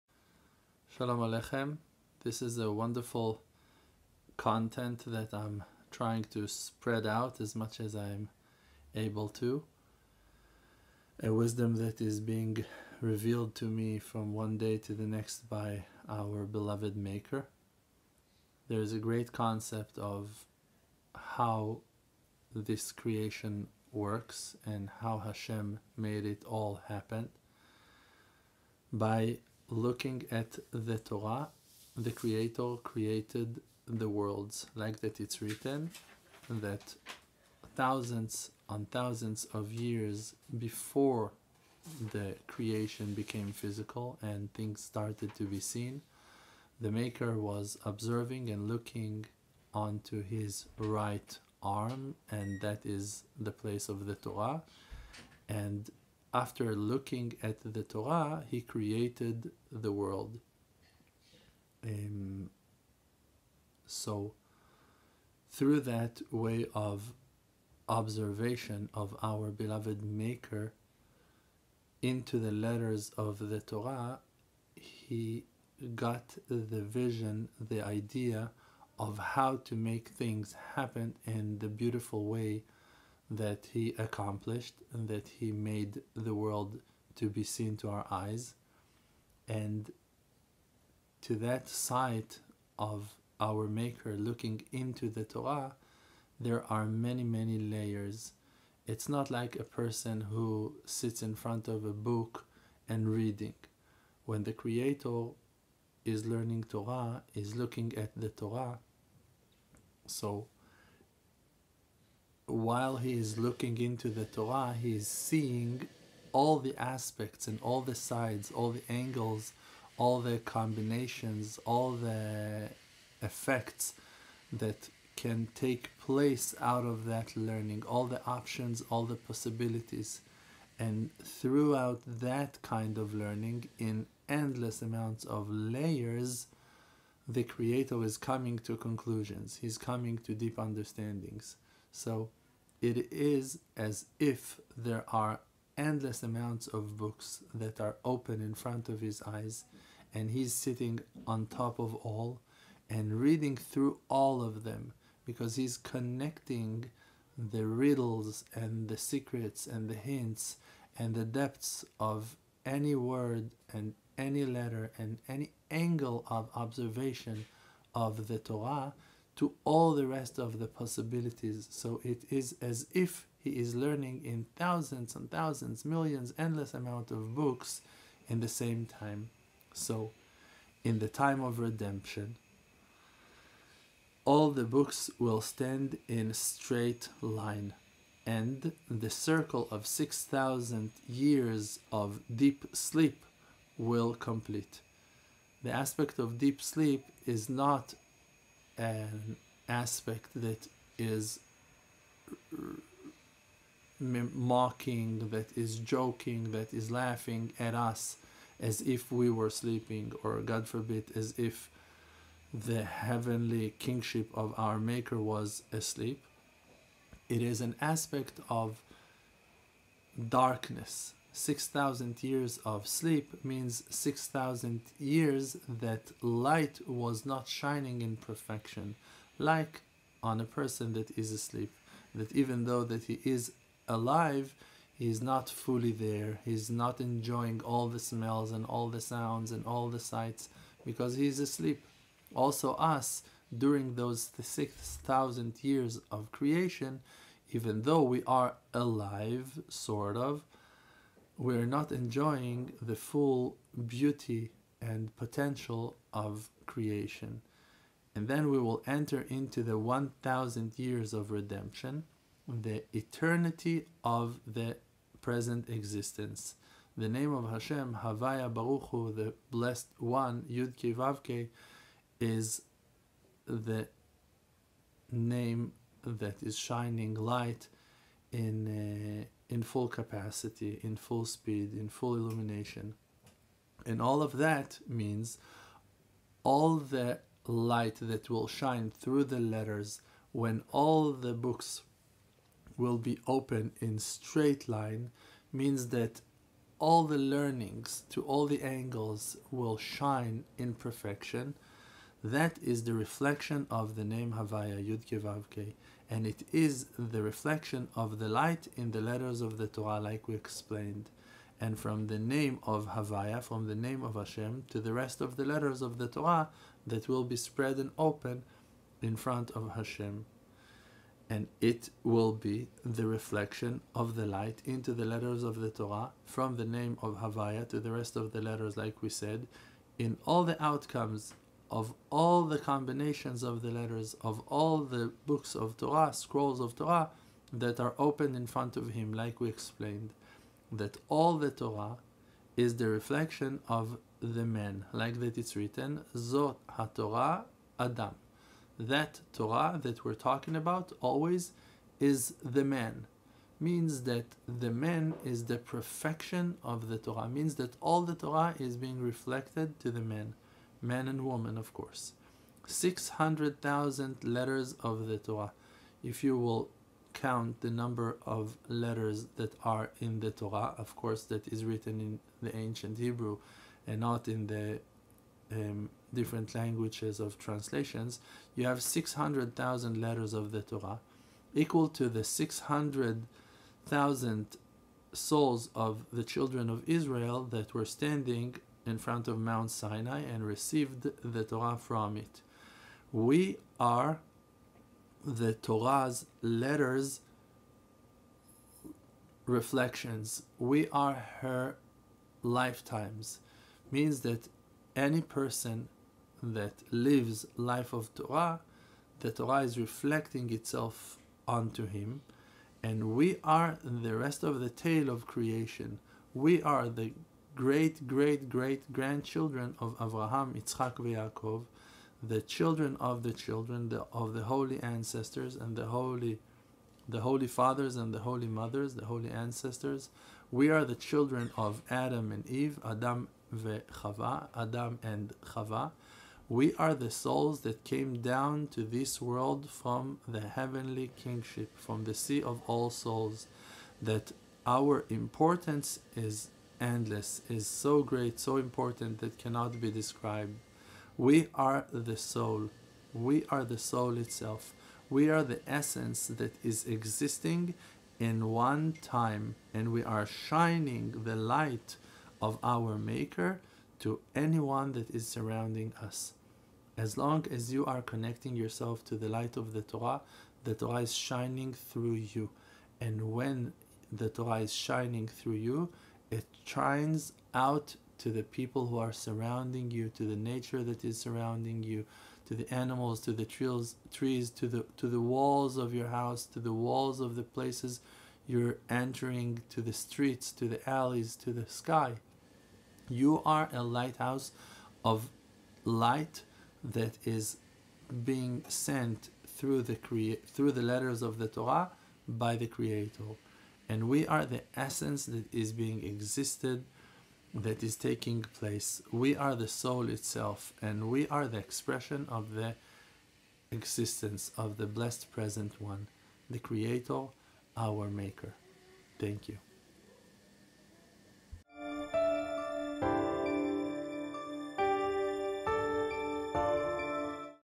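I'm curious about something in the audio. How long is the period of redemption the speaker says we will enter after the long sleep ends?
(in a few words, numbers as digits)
1000 years.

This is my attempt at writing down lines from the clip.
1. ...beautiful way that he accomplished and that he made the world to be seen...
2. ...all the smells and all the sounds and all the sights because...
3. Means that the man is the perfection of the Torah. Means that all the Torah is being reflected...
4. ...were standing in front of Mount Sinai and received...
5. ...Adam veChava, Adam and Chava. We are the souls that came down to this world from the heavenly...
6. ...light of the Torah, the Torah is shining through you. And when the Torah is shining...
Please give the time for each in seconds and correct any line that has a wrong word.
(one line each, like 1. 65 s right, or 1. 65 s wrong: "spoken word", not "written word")
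1. 81 s right
2. 237 s right
3. 353 s right
4. 387 s right
5. 432 s right
6. 469 s right.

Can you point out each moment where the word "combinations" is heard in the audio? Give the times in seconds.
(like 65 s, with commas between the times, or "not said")
120 s, 332 s.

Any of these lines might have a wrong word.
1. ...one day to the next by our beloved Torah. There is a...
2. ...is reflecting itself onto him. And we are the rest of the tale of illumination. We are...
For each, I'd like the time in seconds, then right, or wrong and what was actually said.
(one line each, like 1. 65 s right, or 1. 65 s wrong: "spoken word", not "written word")
1. 14 s wrong: "Maker", not "Torah"
2. 409 s wrong: "creation", not "illumination".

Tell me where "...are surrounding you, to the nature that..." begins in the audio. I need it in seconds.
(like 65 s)
478 s.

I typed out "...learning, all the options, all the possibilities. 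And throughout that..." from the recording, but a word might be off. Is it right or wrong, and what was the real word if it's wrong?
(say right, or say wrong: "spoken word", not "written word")
right.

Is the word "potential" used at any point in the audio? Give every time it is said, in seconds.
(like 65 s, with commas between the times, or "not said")
255 s.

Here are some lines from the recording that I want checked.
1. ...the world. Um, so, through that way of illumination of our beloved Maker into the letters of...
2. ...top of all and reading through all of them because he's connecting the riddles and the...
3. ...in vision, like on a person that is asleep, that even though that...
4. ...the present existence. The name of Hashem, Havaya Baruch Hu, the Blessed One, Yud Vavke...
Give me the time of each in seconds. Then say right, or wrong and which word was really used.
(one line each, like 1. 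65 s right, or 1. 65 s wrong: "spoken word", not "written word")
1. 59 s wrong: "observation", not "illumination"
2. 151 s right
3. 228 s wrong: "perfection", not "vision"
4. 264 s right.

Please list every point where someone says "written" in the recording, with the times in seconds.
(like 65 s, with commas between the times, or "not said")
35 s, 345 s, 371 s.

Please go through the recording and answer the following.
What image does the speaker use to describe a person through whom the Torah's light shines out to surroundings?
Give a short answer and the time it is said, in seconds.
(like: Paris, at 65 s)
a lighthouse, at 493 s.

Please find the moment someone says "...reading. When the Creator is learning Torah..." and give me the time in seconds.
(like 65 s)
103 s.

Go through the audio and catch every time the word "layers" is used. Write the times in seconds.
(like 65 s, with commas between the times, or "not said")
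97 s, 135 s.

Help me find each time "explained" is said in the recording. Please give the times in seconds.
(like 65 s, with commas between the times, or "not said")
310 s, 339 s.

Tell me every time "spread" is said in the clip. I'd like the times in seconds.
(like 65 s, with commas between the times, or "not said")
6 s, 317 s.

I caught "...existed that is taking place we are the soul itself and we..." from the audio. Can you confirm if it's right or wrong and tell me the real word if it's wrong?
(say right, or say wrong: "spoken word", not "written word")
right.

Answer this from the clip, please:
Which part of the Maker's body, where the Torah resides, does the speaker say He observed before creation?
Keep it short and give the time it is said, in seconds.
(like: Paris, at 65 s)
right arm, at 50 s.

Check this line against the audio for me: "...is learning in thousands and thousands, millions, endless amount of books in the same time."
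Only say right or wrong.
right.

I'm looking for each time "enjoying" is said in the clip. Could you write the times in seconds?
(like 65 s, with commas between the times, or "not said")
236 s, 251 s.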